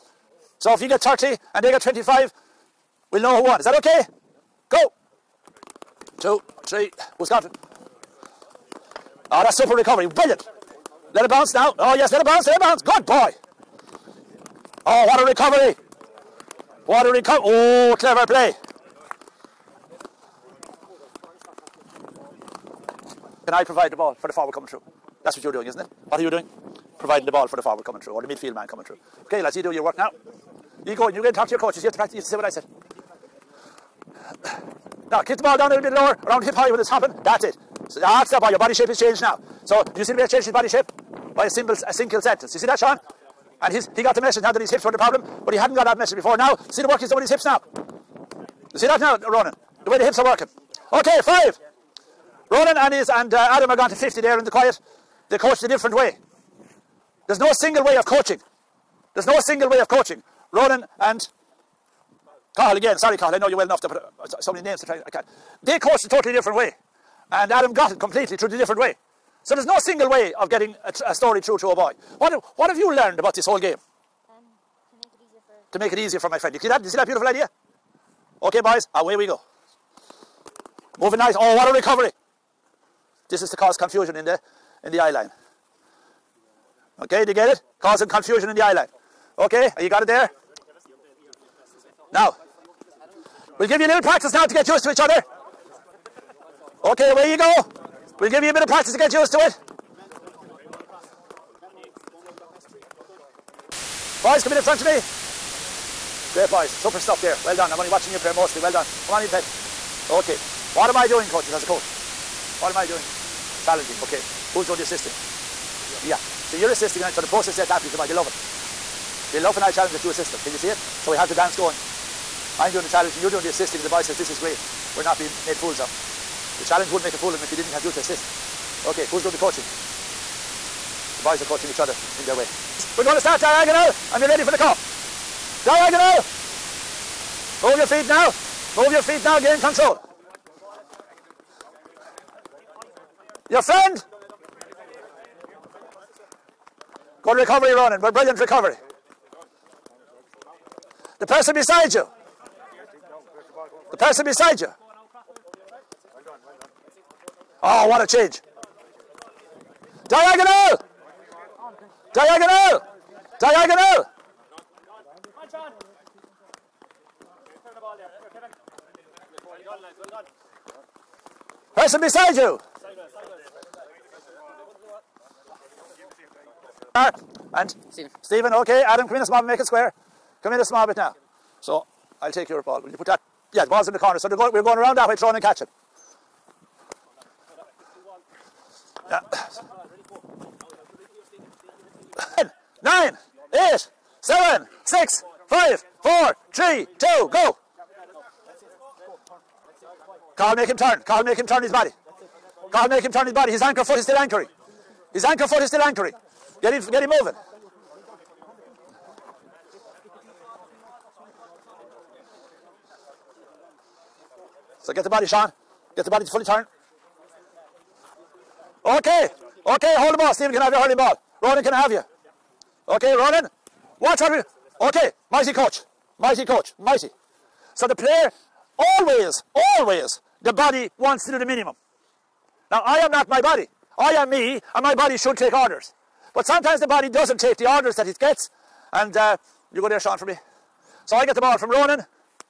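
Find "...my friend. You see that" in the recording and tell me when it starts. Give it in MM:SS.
01:16.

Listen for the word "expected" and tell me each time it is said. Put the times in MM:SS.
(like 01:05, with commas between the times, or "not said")
not said.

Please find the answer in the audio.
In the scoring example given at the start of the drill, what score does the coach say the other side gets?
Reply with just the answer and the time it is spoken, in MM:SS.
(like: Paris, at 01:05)
25, at 00:01.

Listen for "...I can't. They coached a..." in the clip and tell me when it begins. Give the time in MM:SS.
01:05.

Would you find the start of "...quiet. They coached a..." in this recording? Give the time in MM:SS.
00:54.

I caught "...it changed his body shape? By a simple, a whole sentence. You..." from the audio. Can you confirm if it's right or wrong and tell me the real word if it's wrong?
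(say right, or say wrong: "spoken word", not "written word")
wrong: "single", not "whole".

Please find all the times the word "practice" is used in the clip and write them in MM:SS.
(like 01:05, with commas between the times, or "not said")
00:31, 01:34, 01:38.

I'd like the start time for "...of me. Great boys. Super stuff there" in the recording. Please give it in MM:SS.
01:44.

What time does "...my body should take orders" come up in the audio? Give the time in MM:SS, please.
03:54.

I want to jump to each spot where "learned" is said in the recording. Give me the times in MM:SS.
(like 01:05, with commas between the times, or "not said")
01:12.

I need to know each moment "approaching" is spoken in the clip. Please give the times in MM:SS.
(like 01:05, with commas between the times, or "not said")
not said.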